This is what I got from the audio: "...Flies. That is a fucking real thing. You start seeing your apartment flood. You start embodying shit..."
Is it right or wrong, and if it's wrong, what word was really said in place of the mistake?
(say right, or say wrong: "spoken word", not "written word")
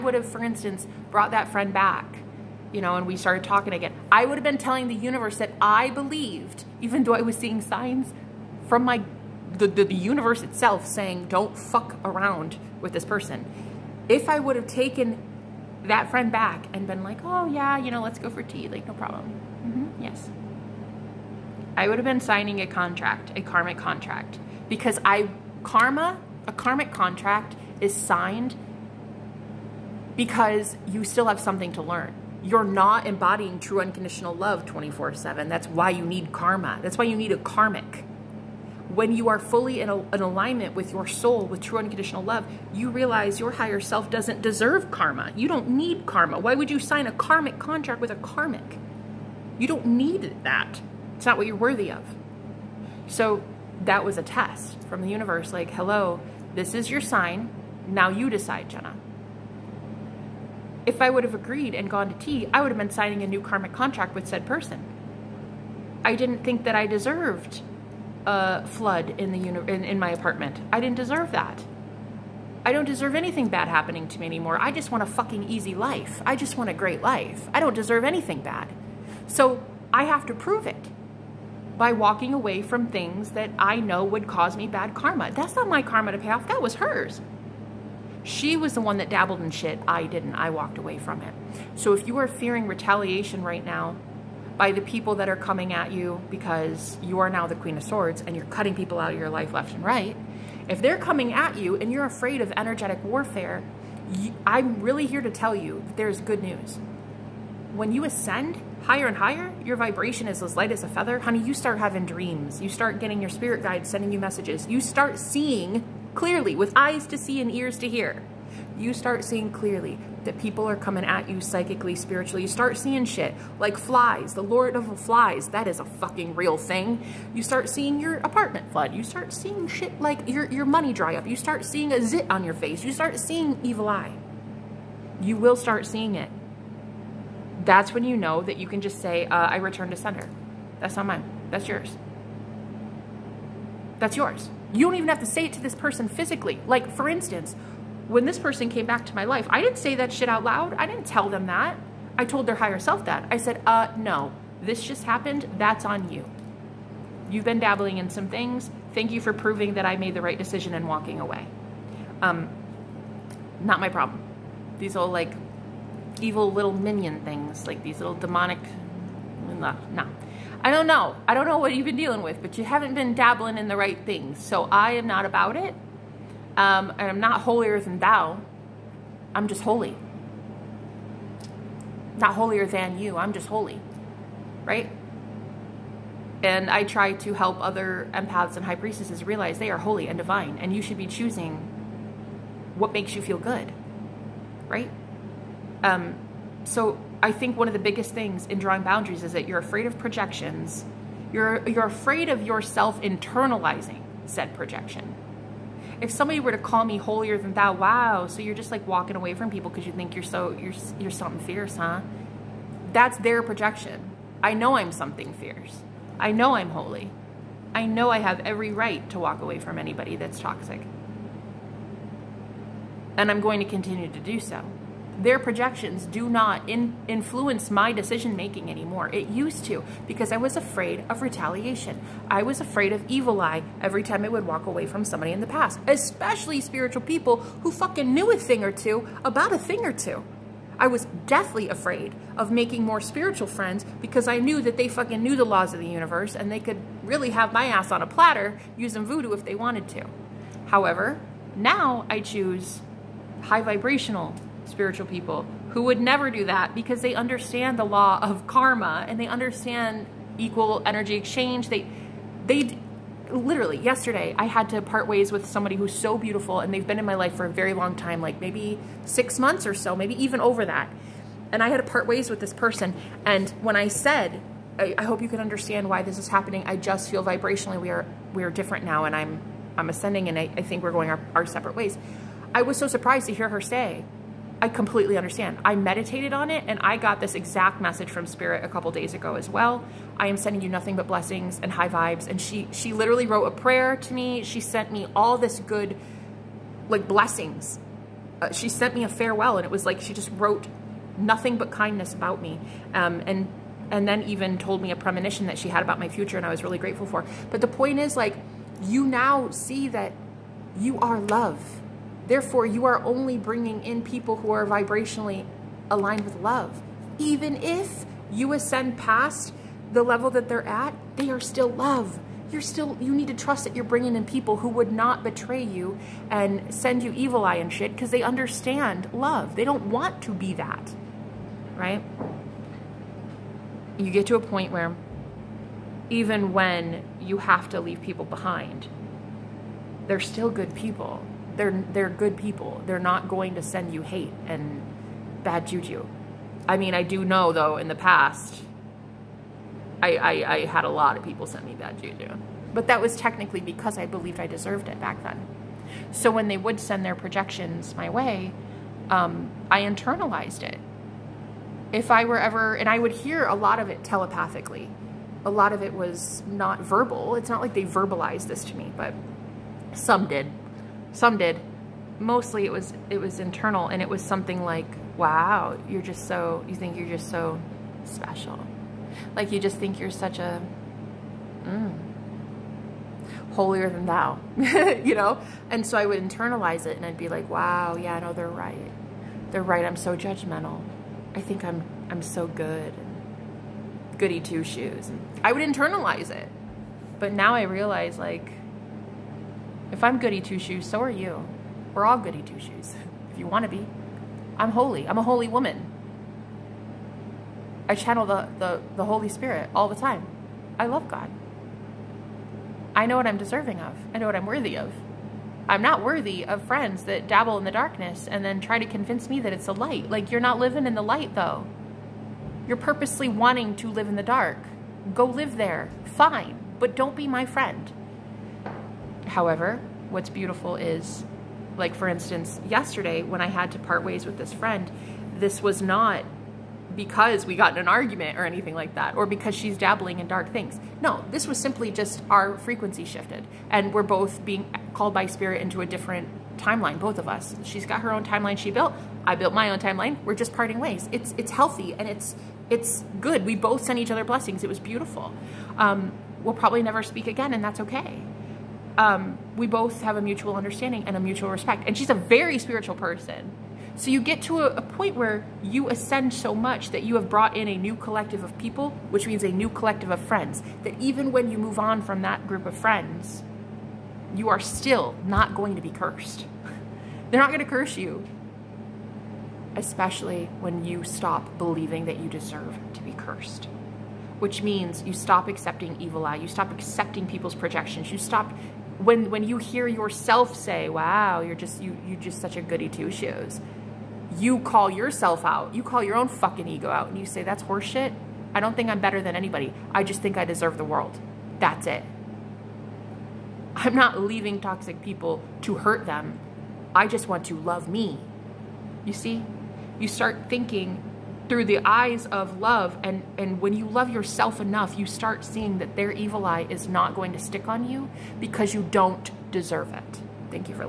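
wrong: "seeing", not "embodying".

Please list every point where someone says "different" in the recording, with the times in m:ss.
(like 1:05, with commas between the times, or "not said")
4:38, 7:25.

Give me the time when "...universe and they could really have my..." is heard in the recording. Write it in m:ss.
4:05.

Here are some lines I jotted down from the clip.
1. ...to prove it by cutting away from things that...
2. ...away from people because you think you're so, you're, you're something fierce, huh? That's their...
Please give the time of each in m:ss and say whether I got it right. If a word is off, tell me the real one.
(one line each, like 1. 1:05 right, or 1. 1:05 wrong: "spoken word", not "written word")
1. 1:20 wrong: "walking", not "cutting"
2. 3:29 right.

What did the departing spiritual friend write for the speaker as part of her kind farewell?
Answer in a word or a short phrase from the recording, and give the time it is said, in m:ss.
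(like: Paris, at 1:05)
a prayer, at 4:53.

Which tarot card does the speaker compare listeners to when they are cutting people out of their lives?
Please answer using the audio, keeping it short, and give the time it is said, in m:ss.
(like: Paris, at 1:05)
Queen of Swords, at 1:37.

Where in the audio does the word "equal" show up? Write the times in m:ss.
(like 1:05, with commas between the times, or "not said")
4:20.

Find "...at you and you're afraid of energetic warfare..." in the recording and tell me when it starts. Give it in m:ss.
1:41.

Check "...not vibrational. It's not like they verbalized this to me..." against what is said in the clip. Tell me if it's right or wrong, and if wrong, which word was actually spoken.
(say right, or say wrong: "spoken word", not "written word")
wrong: "verbal", not "vibrational".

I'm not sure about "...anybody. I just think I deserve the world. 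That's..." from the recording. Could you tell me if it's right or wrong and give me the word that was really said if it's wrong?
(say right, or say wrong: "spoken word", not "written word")
right.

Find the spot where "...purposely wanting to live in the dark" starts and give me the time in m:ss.
7:02.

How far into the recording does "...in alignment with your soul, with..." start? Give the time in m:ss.
0:40.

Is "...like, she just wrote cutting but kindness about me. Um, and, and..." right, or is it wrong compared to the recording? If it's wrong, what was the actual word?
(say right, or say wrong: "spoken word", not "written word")
wrong: "nothing", not "cutting".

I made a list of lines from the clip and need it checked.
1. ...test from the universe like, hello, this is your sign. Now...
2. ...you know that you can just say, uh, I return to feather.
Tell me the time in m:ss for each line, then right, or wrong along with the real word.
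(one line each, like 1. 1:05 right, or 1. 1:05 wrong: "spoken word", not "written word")
1. 0:54 right
2. 2:18 wrong: "sender", not "feather".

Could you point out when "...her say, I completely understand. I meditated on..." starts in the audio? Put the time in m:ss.
4:43.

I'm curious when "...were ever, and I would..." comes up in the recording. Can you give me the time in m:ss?
6:02.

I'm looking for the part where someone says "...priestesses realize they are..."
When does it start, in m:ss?
3:08.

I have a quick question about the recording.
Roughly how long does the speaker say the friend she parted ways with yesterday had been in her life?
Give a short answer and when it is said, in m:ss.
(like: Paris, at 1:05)
6 months, at 4:29.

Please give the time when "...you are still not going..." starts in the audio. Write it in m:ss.
7:54.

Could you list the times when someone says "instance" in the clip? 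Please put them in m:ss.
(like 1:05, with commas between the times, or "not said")
0:00, 2:27, 7:12.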